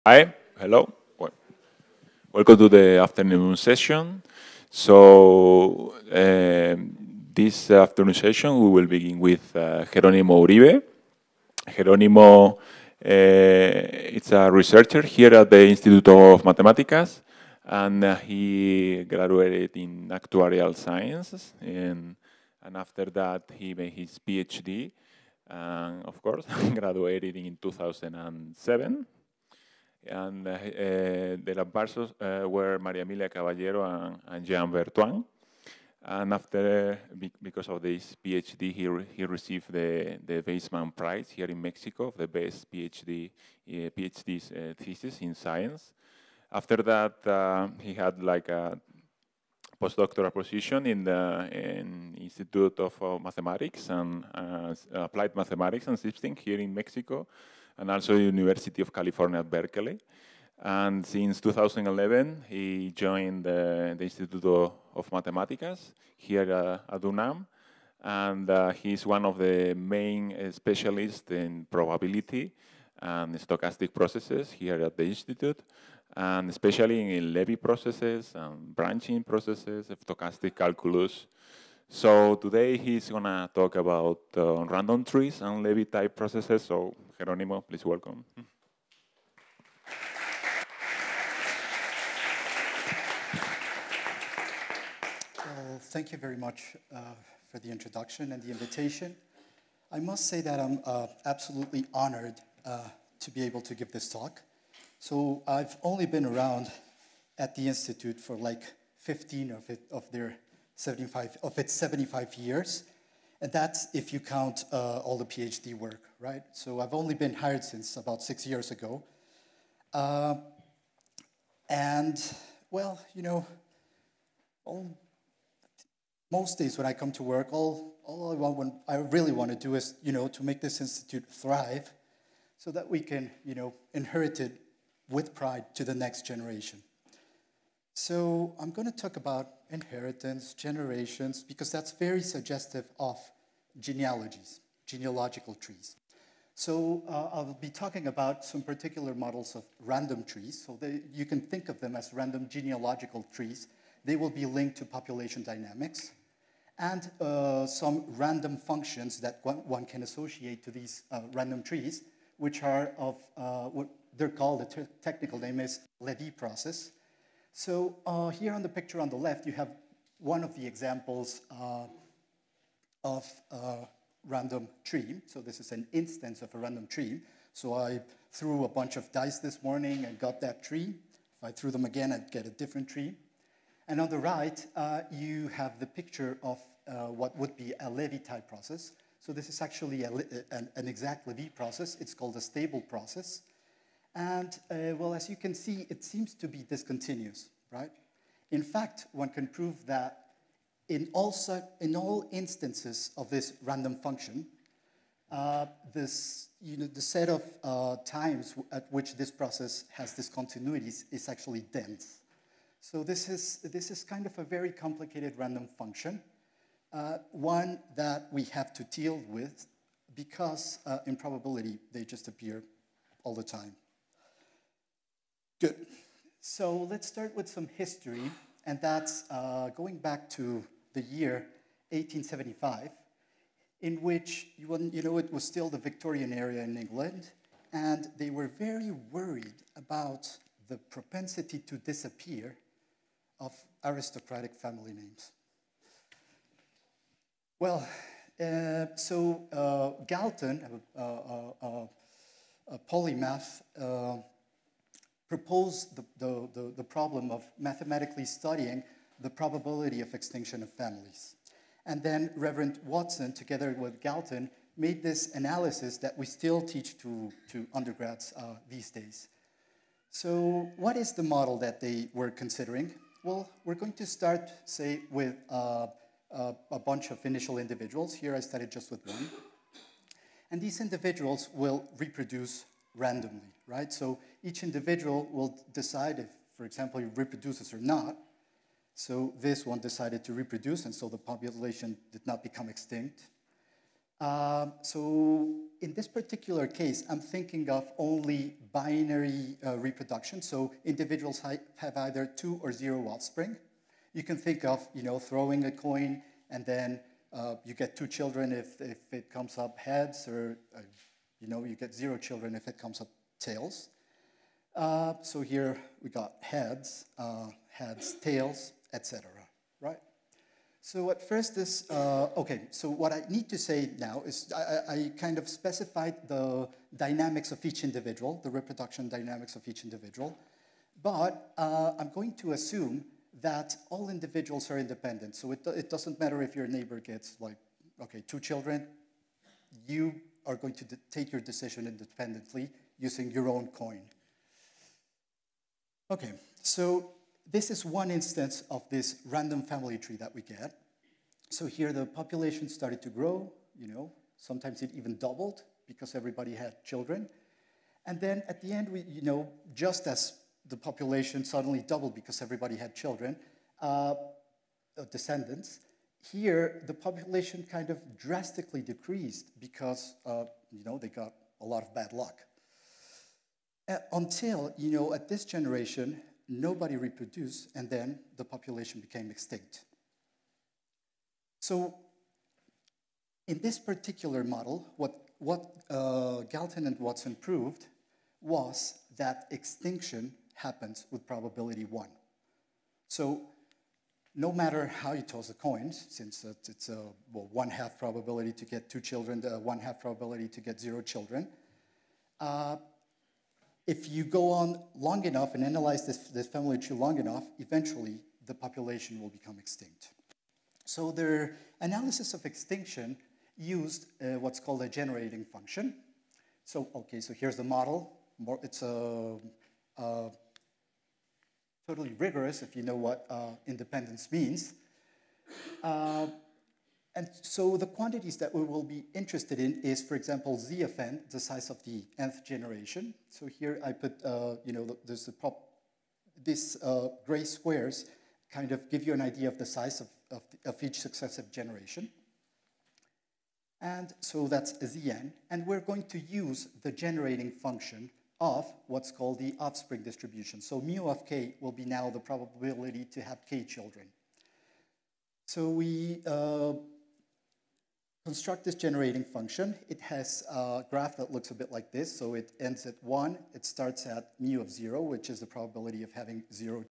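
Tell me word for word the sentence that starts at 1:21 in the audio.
So today he's gonna talk about uh, random trees and Lévy type processes.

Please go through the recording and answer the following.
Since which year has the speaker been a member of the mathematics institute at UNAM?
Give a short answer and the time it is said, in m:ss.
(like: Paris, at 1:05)
2011, at 1:01.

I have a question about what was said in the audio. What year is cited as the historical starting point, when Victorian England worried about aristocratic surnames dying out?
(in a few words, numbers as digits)
1875.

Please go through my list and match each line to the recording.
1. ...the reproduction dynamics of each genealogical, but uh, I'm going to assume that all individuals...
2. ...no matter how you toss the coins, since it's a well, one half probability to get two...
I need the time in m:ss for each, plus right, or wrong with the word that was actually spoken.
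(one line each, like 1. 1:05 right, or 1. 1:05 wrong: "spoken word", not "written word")
1. 5:28 wrong: "individual", not "genealogical"
2. 6:34 right.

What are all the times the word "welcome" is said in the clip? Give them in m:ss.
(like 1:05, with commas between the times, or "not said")
0:02, 1:27.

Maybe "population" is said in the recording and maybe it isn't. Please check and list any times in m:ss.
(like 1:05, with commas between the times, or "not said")
2:34, 4:51, 5:52, 6:00, 6:06, 6:18, 6:48.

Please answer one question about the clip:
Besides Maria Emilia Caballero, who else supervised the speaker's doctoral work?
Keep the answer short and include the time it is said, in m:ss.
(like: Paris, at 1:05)
Jean Bertoin, at 0:34.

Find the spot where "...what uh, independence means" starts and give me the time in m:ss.
7:02.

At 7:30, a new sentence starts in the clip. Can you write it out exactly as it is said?
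So mu of k will be now the probability to have k children.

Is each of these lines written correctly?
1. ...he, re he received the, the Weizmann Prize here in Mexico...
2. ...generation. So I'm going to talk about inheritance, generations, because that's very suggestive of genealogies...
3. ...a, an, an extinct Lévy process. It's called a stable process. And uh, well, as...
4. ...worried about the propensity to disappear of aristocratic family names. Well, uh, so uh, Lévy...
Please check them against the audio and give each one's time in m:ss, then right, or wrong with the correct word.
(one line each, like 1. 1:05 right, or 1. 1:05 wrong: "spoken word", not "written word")
1. 0:38 right
2. 2:16 right
3. 3:10 wrong: "exact", not "extinct"
4. 3:59 wrong: "Galton", not "Lévy".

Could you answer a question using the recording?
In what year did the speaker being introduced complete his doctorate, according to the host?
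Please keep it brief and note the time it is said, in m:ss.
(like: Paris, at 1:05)
2007, at 0:27.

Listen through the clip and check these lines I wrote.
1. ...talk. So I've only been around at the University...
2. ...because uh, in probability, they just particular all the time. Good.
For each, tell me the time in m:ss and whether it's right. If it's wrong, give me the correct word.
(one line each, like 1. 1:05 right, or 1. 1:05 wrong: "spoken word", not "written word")
1. 1:44 wrong: "Institute", not "University"
2. 3:40 wrong: "appear", not "particular".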